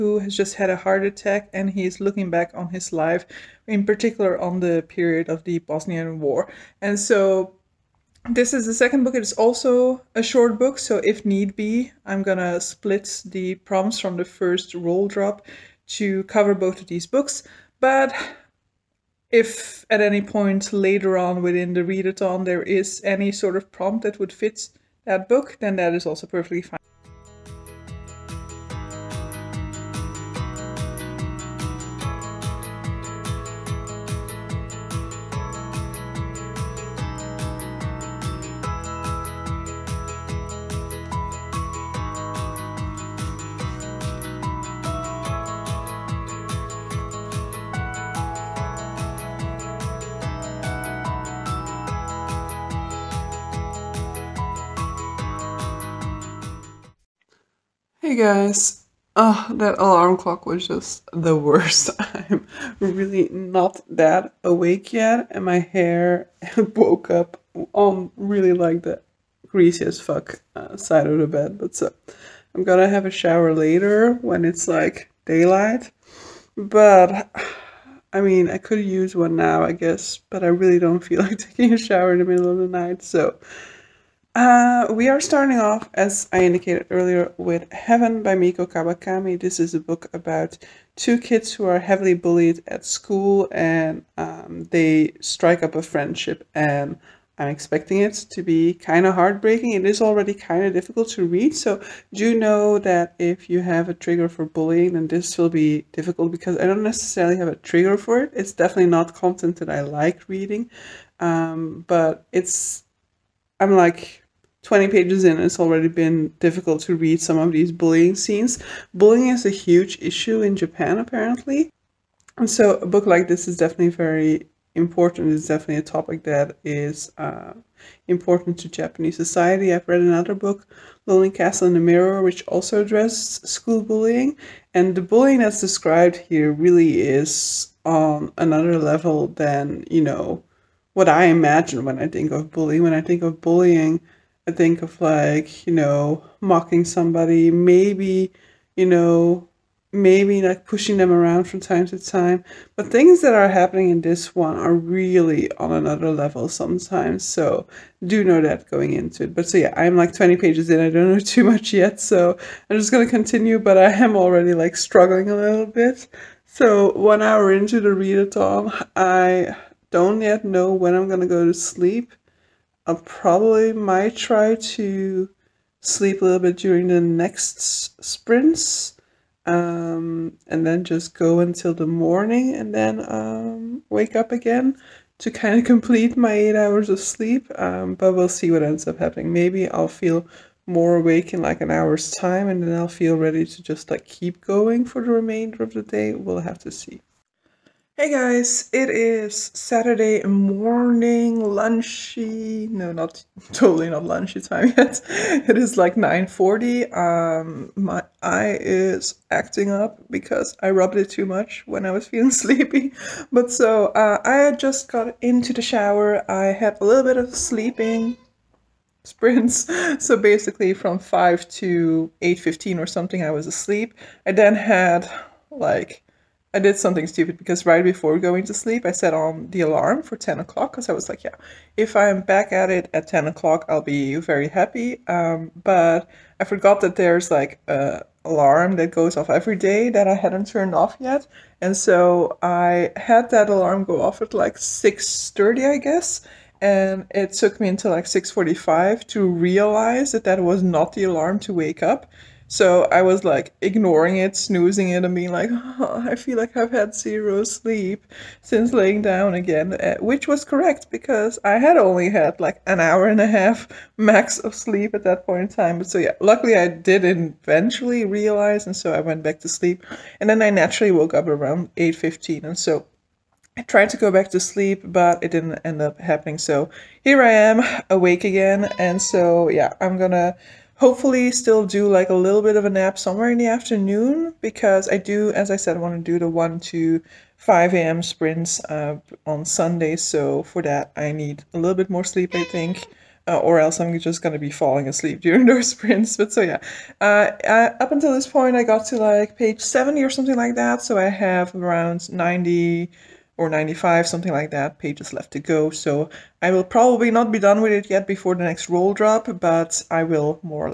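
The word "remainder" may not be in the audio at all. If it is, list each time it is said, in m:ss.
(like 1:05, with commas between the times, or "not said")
3:15.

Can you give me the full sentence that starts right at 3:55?
Um, but I forgot that there's like a alarm that goes off every day that I hadn't turned off yet.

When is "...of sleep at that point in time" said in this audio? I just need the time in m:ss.
4:24.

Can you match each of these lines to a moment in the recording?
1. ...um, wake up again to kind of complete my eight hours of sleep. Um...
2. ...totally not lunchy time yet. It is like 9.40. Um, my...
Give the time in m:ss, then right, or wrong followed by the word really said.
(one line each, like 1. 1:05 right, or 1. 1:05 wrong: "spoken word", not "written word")
1. 3:03 right
2. 3:23 right.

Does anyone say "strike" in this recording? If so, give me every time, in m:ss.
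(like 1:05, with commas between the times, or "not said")
1:35.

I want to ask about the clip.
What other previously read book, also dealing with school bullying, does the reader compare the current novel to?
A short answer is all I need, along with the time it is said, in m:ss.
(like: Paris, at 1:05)
Lonely Castle in the Mirror, at 2:11.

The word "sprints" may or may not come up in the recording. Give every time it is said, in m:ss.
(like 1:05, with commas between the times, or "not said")
2:58, 3:39, 4:48, 4:55.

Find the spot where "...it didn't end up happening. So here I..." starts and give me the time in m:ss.
4:35.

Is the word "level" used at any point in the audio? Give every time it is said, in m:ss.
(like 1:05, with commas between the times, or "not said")
2:18, 2:36.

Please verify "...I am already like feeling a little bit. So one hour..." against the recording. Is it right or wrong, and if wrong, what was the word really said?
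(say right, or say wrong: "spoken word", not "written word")
wrong: "struggling", not "feeling".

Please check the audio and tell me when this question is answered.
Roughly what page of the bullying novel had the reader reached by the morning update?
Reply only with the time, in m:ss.
4:59.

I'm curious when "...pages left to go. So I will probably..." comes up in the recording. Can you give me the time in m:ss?
5:04.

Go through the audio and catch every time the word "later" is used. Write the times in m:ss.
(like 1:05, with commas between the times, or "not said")
0:20, 1:13.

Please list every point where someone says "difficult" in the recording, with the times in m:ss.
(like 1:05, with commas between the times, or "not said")
1:40, 1:45, 1:56.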